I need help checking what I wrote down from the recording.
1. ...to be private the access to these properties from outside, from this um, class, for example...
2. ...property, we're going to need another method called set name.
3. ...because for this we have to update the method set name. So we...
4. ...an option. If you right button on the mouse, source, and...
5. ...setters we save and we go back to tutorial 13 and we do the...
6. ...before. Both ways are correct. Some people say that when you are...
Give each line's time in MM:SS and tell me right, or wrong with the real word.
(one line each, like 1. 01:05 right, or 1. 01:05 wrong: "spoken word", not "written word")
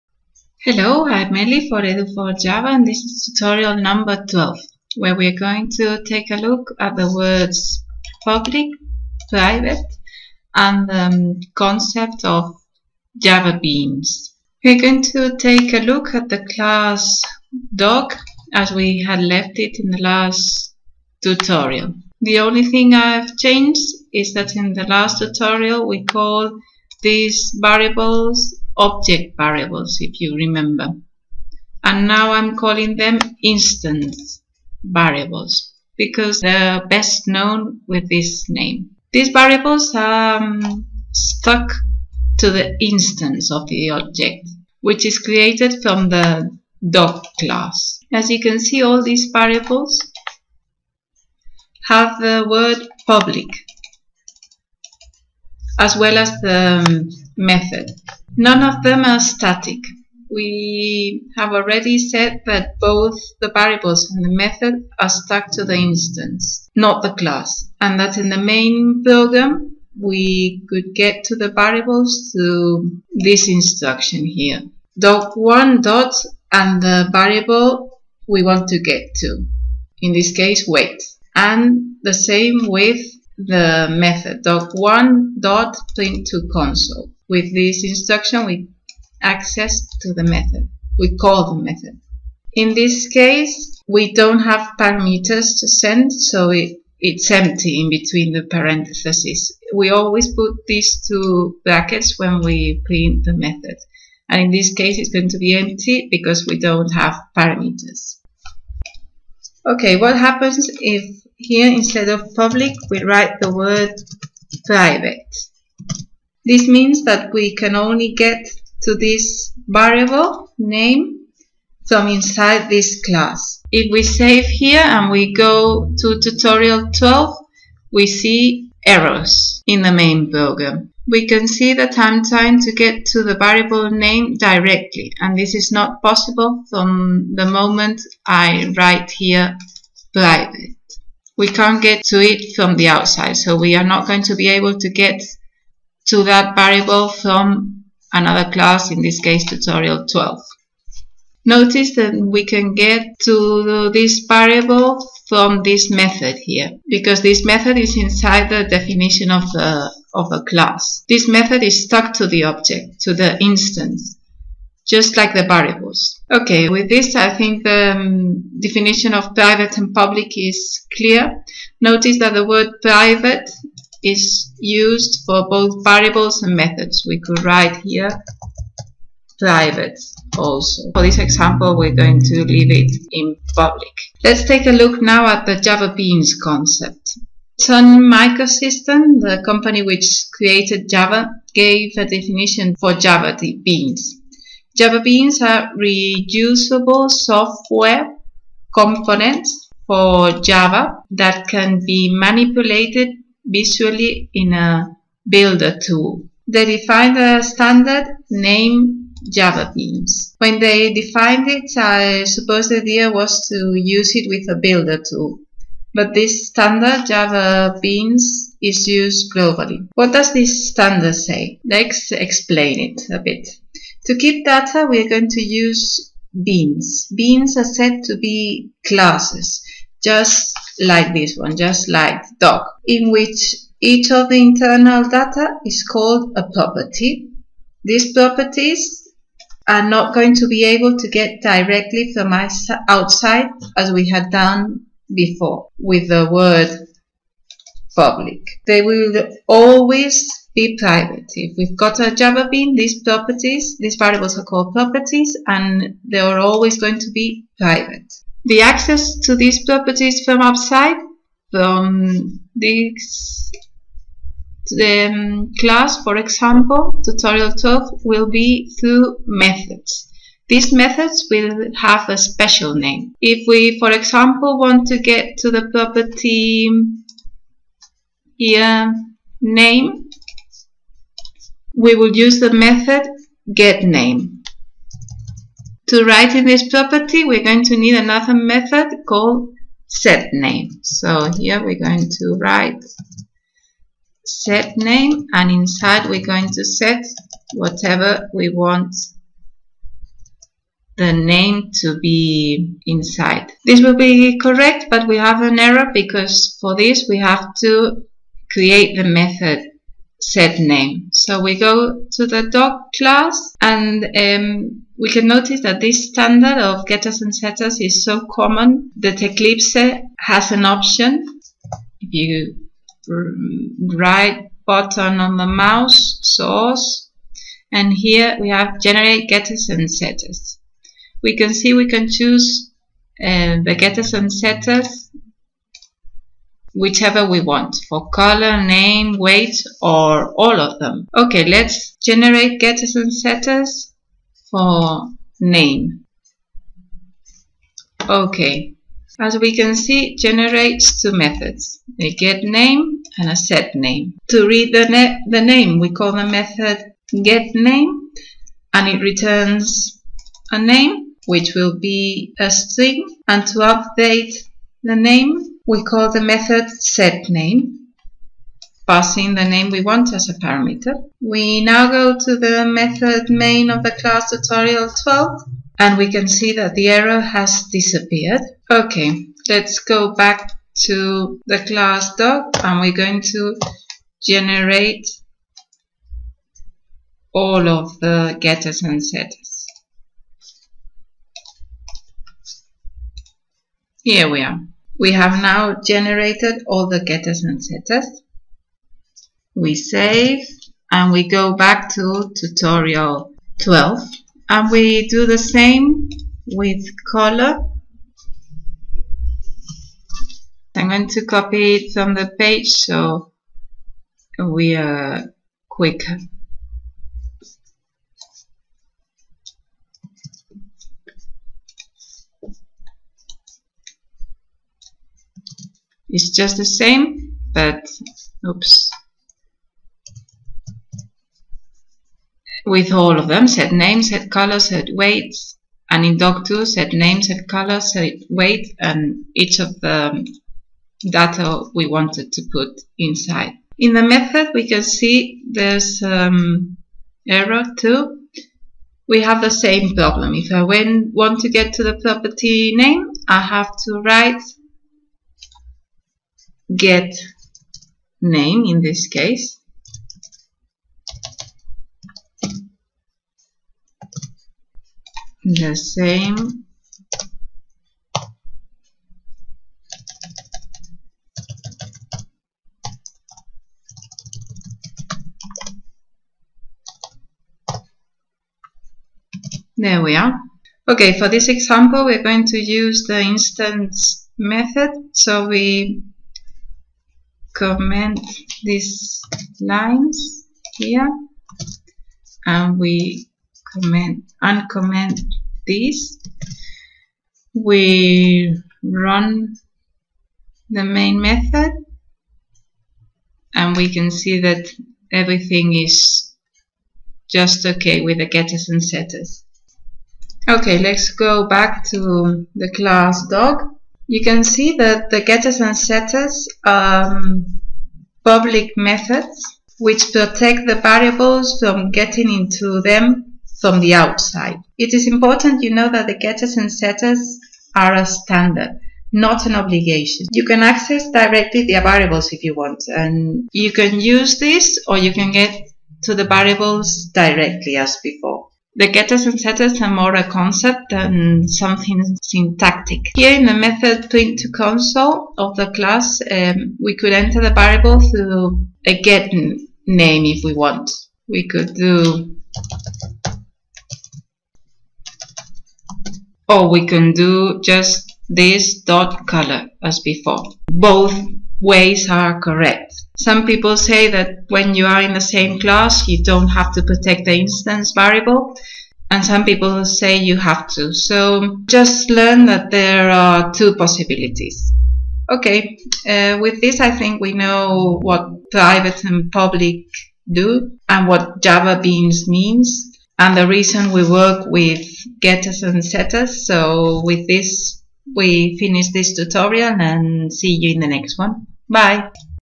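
1. 04:16 right
2. 04:46 right
3. 05:05 wrong: "create", not "update"
4. 05:20 right
5. 06:37 wrong: "12", not "13"
6. 09:20 right.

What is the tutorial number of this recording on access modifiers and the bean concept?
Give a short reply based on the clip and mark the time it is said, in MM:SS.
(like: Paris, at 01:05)
12, at 00:03.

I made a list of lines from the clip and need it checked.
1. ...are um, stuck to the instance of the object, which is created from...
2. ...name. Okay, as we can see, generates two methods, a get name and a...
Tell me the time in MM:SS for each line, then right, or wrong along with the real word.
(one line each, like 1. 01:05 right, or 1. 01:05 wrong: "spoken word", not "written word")
1. 00:39 right
2. 05:45 right.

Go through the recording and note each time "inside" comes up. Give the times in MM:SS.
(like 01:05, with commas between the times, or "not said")
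02:02, 02:37, 04:55, 05:02, 07:22.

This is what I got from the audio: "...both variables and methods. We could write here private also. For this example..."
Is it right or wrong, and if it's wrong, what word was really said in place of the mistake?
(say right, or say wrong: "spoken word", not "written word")
right.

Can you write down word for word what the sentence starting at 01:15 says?
Dog1 dot and the variable we want to get to, in this case weight.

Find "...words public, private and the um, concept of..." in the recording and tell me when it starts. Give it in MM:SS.
00:07.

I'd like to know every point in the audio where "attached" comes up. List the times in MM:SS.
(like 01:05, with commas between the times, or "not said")
not said.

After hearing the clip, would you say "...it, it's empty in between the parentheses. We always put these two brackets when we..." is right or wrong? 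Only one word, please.
right.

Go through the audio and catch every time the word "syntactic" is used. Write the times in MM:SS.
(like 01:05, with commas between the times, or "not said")
09:02.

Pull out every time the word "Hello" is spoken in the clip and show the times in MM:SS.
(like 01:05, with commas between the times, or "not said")
00:00.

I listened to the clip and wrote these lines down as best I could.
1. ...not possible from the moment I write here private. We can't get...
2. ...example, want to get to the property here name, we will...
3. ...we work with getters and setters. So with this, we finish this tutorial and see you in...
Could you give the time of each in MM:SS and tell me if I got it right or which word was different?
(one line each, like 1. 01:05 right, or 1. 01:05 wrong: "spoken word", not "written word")
1. 02:15 right
2. 04:33 right
3. 09:43 right.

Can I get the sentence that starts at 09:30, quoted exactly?
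So just learn that there are two possibilities.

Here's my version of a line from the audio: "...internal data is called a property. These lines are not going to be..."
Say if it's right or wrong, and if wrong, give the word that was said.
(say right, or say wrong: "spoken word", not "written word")
wrong: "properties", not "lines".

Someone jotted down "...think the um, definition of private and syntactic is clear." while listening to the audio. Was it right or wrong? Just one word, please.
wrong.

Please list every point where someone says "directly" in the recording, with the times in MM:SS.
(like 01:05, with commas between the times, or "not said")
02:14, 04:01, 08:51, 08:57.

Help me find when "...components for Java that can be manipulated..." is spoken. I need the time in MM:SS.
03:18.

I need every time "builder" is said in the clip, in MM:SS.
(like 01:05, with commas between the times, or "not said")
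03:25, 03:34.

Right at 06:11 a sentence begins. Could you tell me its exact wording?
We now go to the method main of the class tutorial 12 and we can see that the error has disappeared.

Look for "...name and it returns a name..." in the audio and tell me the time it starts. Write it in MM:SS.
05:57.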